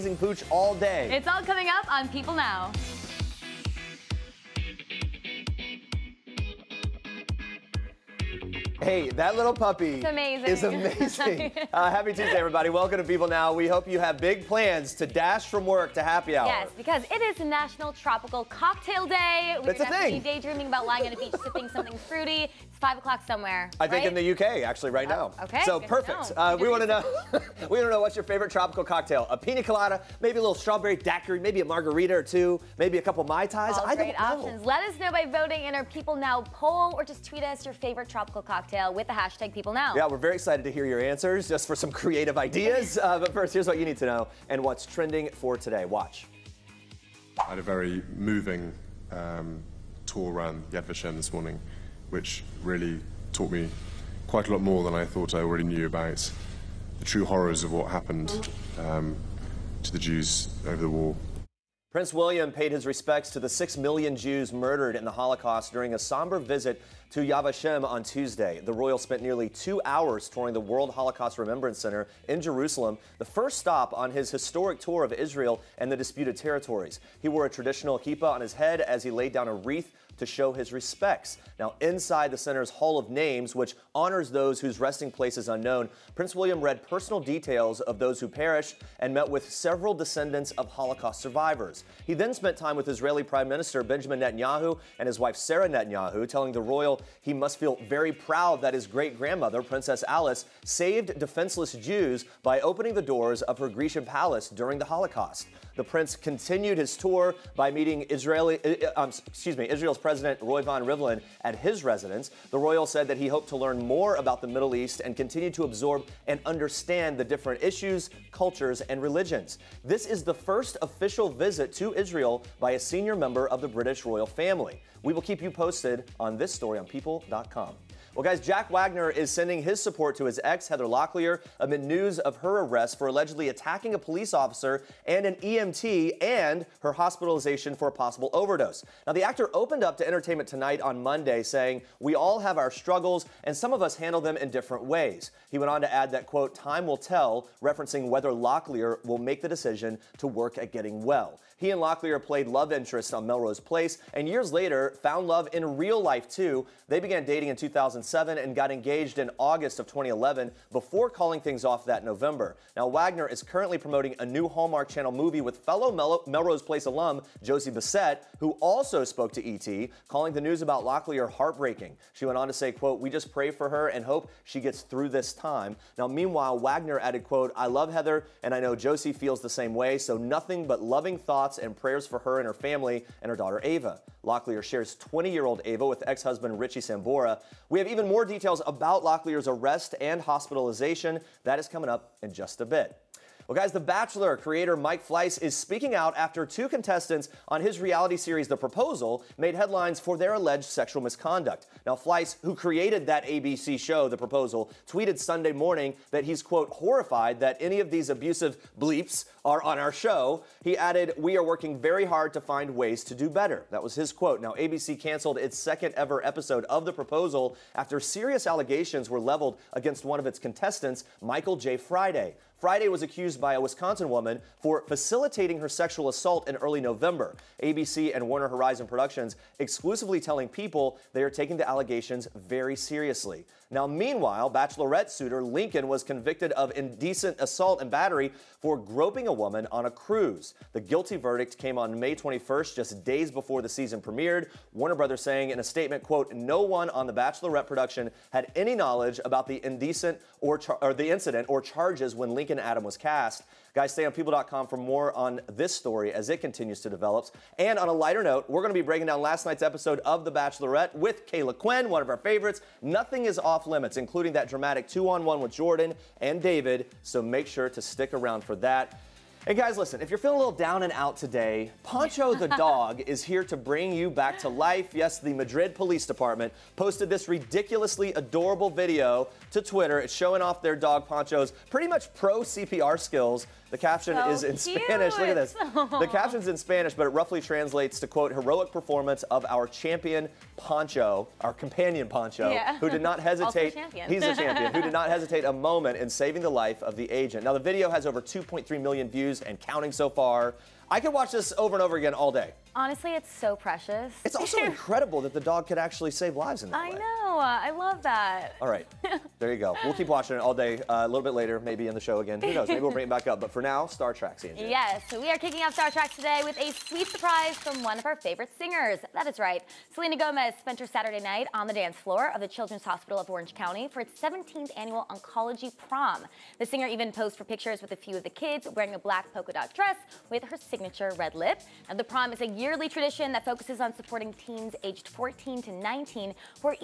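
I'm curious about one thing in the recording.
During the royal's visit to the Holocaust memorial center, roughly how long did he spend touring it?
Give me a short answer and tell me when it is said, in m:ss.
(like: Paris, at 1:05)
nearly two hours, at 1:09.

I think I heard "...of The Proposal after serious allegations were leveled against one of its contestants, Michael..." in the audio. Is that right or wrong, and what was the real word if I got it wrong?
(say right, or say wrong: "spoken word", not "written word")
right.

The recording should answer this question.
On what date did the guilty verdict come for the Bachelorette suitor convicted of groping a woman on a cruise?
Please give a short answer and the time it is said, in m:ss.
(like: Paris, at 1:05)
May 21st, at 4:01.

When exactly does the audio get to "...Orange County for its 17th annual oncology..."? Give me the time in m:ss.
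5:23.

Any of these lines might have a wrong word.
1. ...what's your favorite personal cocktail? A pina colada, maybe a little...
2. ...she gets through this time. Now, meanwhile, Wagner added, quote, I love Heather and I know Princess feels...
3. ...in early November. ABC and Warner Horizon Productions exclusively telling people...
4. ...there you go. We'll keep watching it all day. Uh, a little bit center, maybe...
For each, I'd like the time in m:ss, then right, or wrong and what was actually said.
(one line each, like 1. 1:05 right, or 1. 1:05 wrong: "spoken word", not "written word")
1. 0:28 wrong: "tropical", not "personal"
2. 2:54 wrong: "Josie", not "Princess"
3. 3:46 right
4. 5:09 wrong: "later", not "center".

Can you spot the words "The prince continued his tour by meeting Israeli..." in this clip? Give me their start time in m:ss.
1:45.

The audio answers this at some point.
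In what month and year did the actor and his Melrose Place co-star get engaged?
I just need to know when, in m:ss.
2:39.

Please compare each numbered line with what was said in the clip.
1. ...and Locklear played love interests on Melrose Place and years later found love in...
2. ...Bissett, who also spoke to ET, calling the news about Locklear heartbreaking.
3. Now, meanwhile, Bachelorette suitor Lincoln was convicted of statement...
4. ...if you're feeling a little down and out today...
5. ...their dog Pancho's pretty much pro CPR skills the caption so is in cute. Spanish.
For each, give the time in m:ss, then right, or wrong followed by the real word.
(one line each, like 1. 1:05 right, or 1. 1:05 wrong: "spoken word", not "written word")
1. 2:31 right
2. 2:47 right
3. 3:53 wrong: "indecent", not "statement"
4. 4:30 right
5. 4:40 right.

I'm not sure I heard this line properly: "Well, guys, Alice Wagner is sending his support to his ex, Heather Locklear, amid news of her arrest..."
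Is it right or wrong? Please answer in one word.
wrong.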